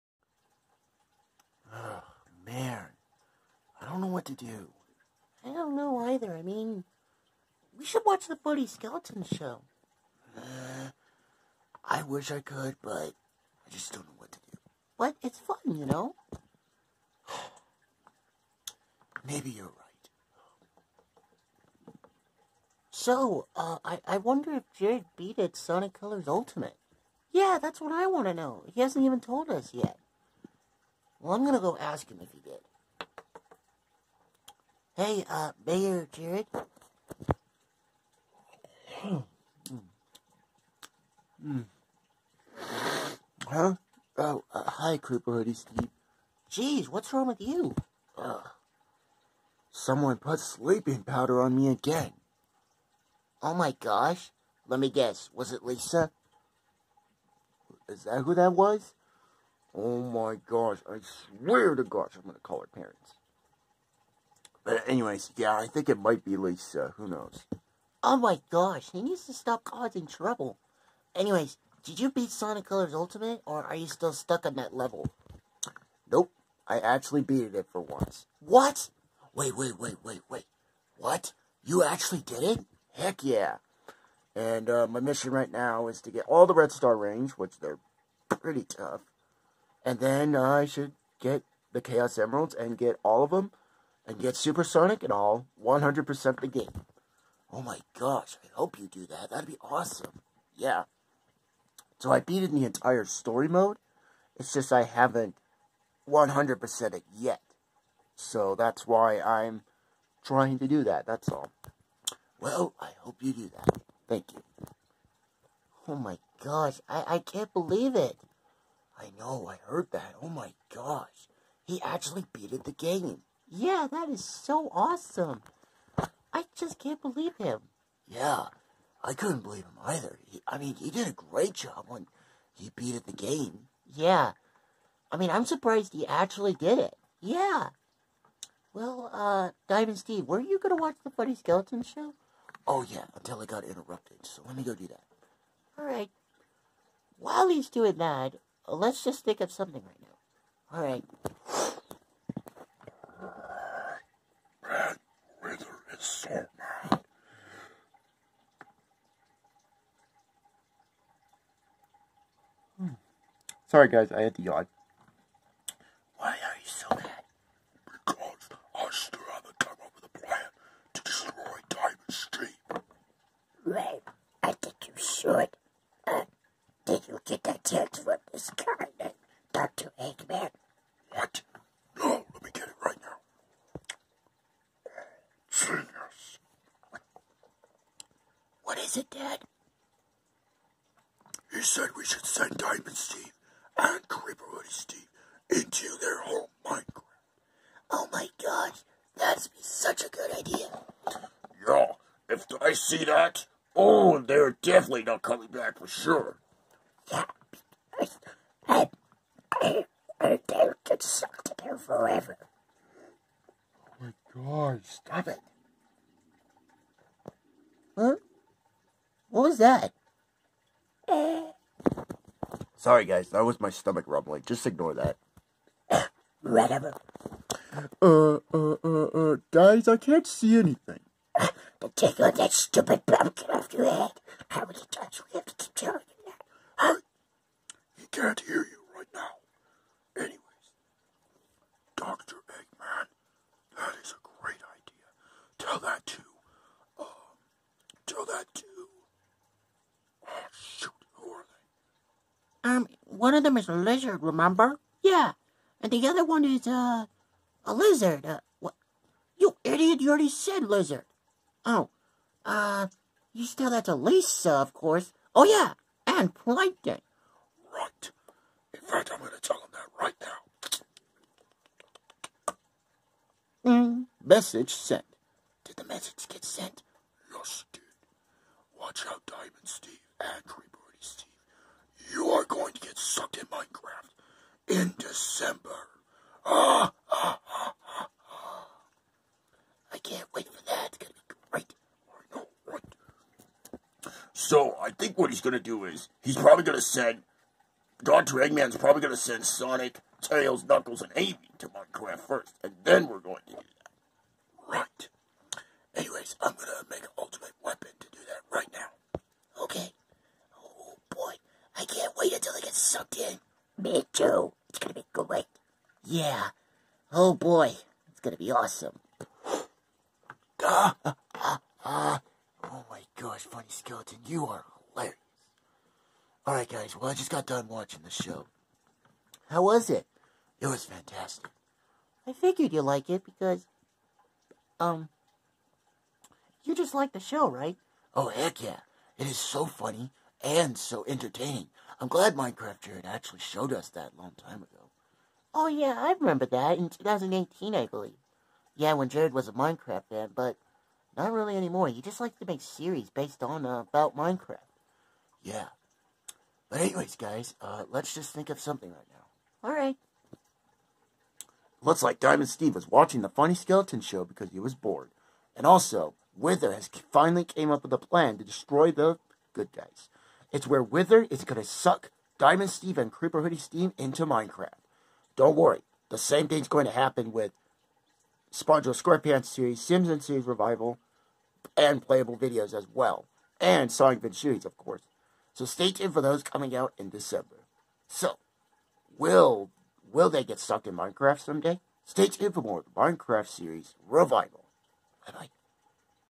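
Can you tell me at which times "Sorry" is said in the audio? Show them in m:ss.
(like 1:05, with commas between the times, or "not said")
2:43, 3:42.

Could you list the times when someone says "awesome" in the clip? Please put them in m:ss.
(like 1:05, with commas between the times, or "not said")
1:39, 2:04, 5:18.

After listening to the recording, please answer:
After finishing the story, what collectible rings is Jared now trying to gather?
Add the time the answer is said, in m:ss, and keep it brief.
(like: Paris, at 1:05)
Red Star Rings, at 1:26.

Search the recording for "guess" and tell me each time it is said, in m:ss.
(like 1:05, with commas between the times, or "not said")
0:54.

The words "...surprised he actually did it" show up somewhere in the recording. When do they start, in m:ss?
2:15.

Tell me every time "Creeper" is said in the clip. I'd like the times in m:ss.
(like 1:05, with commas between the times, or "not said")
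0:44, 3:14, 6:13.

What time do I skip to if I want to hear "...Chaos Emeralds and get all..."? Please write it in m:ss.
1:31.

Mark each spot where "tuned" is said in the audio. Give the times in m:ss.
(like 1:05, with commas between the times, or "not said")
6:25, 6:32.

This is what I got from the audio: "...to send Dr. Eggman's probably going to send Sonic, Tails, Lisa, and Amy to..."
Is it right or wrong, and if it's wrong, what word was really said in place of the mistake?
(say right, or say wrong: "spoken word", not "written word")
wrong: "Knuckles", not "Lisa".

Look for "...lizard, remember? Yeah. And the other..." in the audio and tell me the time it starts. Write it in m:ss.
4:13.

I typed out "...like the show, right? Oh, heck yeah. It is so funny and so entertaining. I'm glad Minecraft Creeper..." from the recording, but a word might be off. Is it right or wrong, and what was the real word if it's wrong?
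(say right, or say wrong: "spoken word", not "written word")
wrong: "Jared", not "Creeper".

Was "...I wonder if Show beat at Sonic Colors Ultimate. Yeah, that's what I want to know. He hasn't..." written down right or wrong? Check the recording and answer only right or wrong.
wrong.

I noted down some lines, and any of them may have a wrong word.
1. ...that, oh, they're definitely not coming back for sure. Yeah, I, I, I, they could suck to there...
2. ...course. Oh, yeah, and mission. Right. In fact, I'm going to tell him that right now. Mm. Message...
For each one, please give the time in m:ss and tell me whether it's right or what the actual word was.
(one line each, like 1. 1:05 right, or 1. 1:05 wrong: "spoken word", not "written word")
1. 3:23 right
2. 4:24 wrong: "plankton", not "mission".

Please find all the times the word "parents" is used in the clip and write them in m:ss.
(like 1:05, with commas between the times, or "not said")
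1:02.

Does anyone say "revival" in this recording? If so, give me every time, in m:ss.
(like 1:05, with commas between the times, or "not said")
6:20, 6:34.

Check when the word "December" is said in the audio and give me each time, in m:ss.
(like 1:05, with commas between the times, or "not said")
4:44, 6:27.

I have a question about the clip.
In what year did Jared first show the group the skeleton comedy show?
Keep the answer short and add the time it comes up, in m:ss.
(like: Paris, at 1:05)
2018, at 5:46.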